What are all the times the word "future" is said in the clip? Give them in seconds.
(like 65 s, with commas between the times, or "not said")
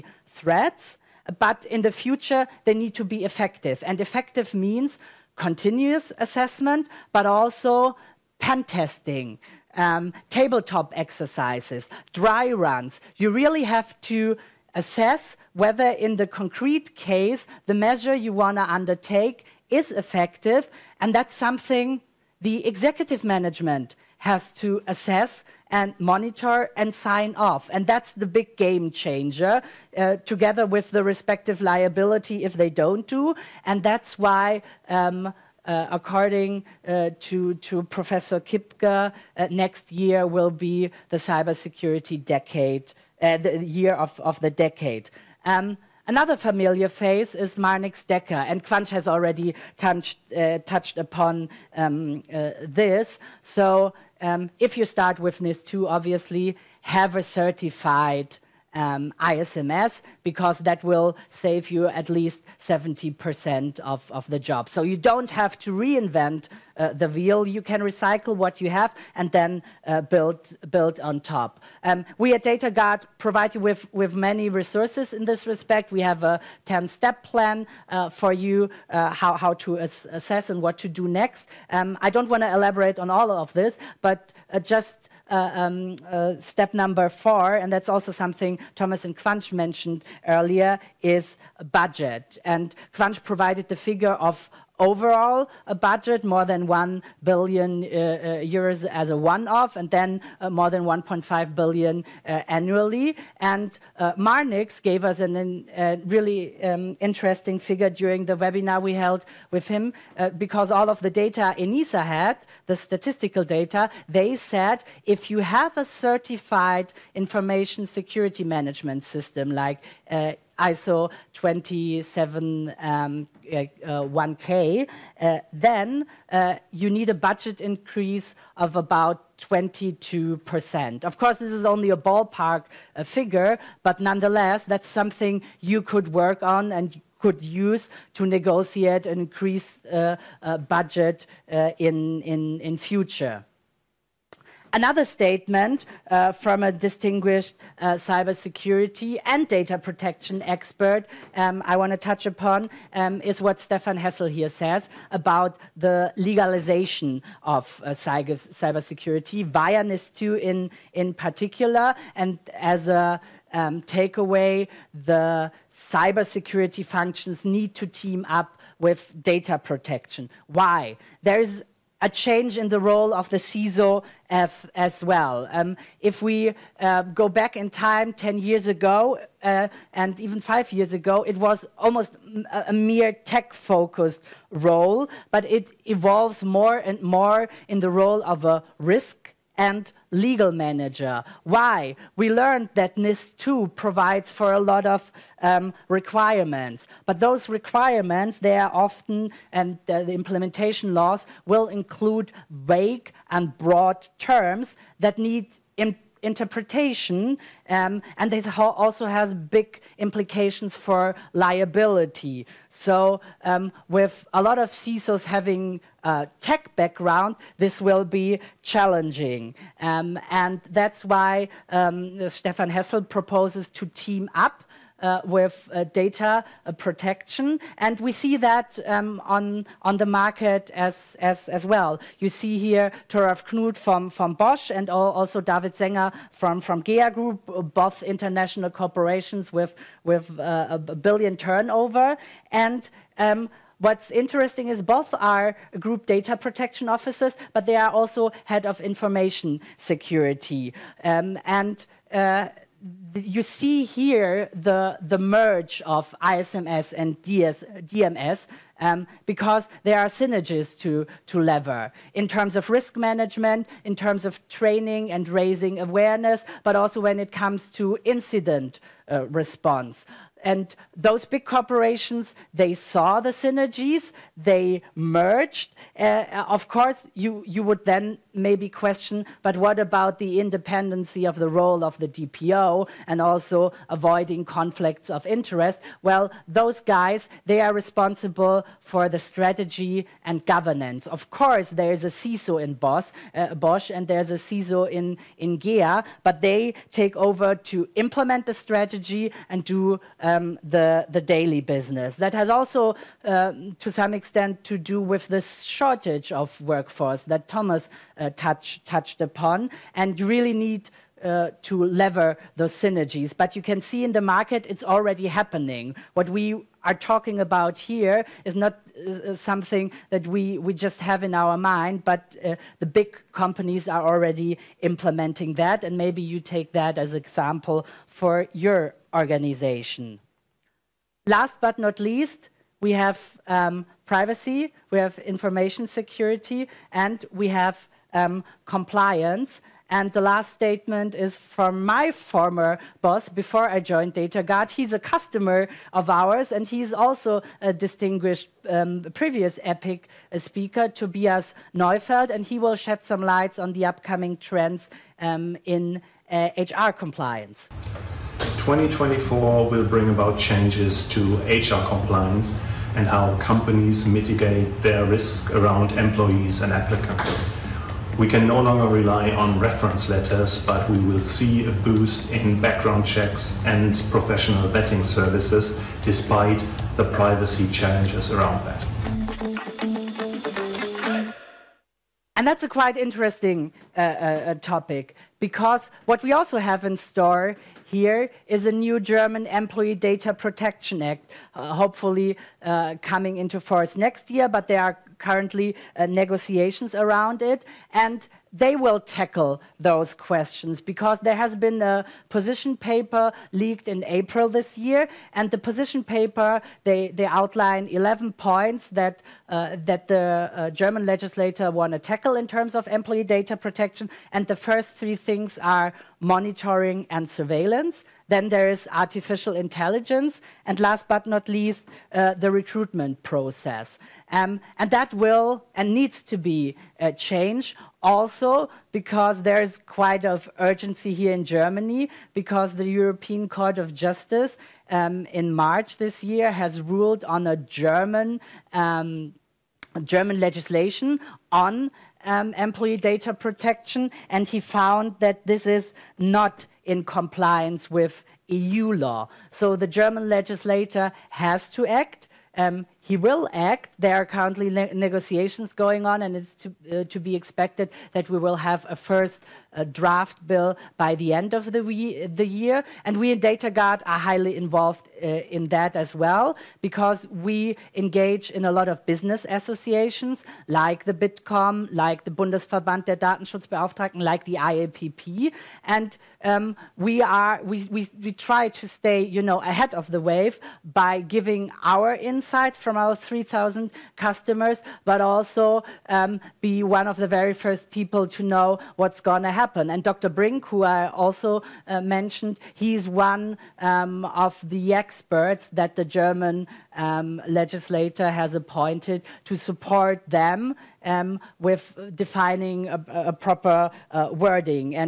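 1 s, 142 s.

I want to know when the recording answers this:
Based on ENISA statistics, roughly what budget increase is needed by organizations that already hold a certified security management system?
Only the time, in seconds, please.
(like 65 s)
129 s.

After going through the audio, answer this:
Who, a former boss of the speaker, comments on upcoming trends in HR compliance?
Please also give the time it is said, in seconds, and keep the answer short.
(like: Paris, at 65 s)
Tobias Neufeld, at 350 s.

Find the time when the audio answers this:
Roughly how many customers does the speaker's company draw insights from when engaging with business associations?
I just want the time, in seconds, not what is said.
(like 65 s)
483 s.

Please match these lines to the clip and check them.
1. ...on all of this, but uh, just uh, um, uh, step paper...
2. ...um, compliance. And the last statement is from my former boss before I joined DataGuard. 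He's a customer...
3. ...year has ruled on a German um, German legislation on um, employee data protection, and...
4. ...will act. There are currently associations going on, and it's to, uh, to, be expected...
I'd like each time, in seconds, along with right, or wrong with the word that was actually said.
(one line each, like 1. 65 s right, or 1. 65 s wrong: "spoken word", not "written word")
1. 82 s wrong: "number", not "paper"
2. 338 s right
3. 436 s right
4. 453 s wrong: "negotiations", not "associations".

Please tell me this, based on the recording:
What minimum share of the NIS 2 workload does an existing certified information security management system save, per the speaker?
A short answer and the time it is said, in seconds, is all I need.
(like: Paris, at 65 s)
70%, at 62 s.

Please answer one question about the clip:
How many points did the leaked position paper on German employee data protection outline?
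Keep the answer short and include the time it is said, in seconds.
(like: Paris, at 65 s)
11, at 407 s.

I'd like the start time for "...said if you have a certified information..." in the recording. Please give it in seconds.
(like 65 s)
114 s.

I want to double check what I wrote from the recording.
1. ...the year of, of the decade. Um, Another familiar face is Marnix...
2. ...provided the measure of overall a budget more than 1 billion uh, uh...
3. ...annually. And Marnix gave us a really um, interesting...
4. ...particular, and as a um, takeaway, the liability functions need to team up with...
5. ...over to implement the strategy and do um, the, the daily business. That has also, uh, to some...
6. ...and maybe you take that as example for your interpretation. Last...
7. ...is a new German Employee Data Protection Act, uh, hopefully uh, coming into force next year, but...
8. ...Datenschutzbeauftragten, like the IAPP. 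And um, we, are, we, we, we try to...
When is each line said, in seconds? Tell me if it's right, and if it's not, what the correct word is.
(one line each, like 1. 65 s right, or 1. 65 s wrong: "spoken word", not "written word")
1. 43 s right
2. 93 s wrong: "figure", not "measure"
3. 102 s right
4. 161 s wrong: "cybersecurity", not "liability"
5. 297 s right
6. 325 s wrong: "organization", not "interpretation"
7. 388 s right
8. 473 s right.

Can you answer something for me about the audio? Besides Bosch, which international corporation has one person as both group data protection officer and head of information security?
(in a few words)
GEA Group.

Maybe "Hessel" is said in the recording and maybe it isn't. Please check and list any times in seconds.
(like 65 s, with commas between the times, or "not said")
153 s, 222 s.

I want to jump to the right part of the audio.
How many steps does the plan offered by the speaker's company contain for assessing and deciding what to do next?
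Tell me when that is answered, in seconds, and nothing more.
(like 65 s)
76 s.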